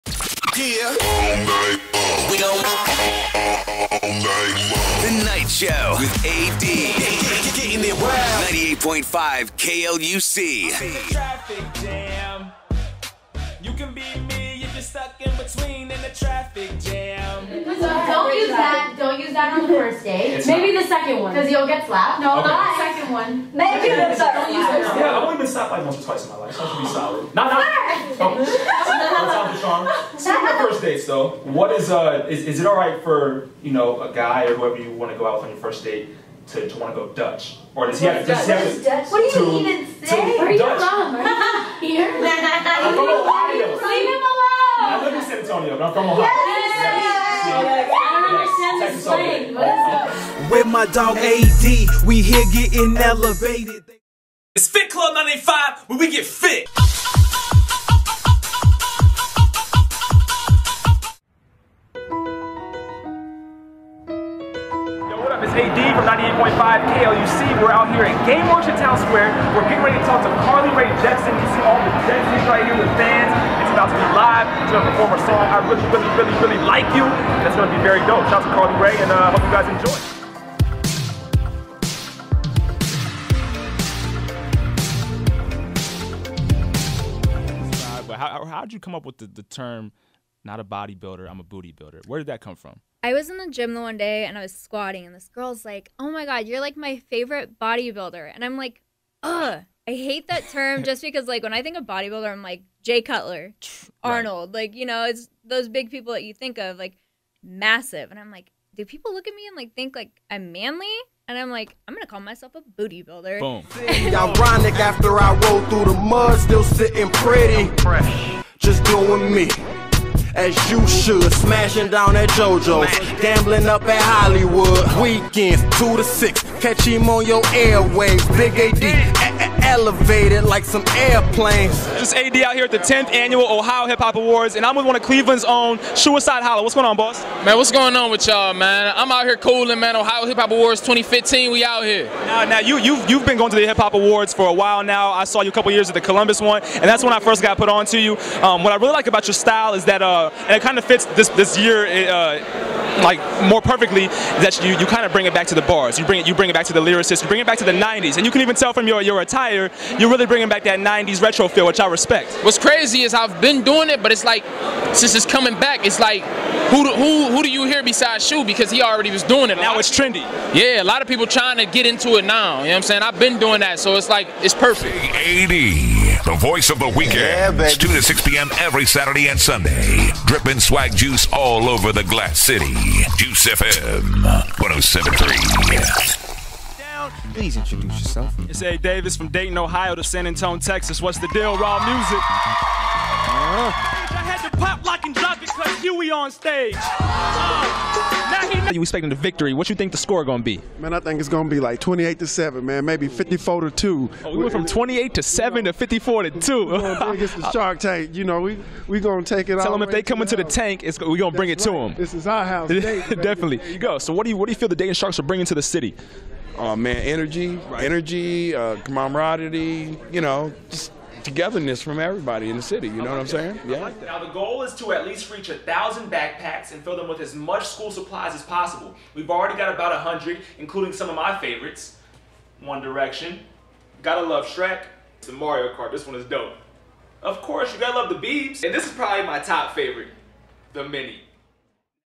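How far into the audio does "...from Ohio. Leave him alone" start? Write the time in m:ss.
0:42.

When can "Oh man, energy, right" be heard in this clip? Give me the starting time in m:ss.
3:36.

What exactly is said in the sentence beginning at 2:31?
It, uh, like more perfectly that you, you kind of bring it back to the bars.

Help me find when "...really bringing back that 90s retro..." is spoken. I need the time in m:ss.
2:40.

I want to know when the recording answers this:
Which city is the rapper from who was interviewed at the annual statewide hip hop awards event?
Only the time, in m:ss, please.
2:15.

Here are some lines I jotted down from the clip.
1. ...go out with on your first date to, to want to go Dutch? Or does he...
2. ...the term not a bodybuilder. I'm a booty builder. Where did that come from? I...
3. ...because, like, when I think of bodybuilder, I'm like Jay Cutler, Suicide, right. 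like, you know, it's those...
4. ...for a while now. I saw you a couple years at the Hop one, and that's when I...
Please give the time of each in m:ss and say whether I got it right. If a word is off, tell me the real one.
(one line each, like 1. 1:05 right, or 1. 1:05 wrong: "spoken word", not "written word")
1. 0:35 right
2. 1:29 right
3. 1:41 wrong: "Arnold", not "Suicide"
4. 2:24 wrong: "Columbus", not "Hop".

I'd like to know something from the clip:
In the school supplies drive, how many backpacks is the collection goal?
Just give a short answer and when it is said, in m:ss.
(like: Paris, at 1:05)
1,000, at 3:45.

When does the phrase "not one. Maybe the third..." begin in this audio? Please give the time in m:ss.
0:22.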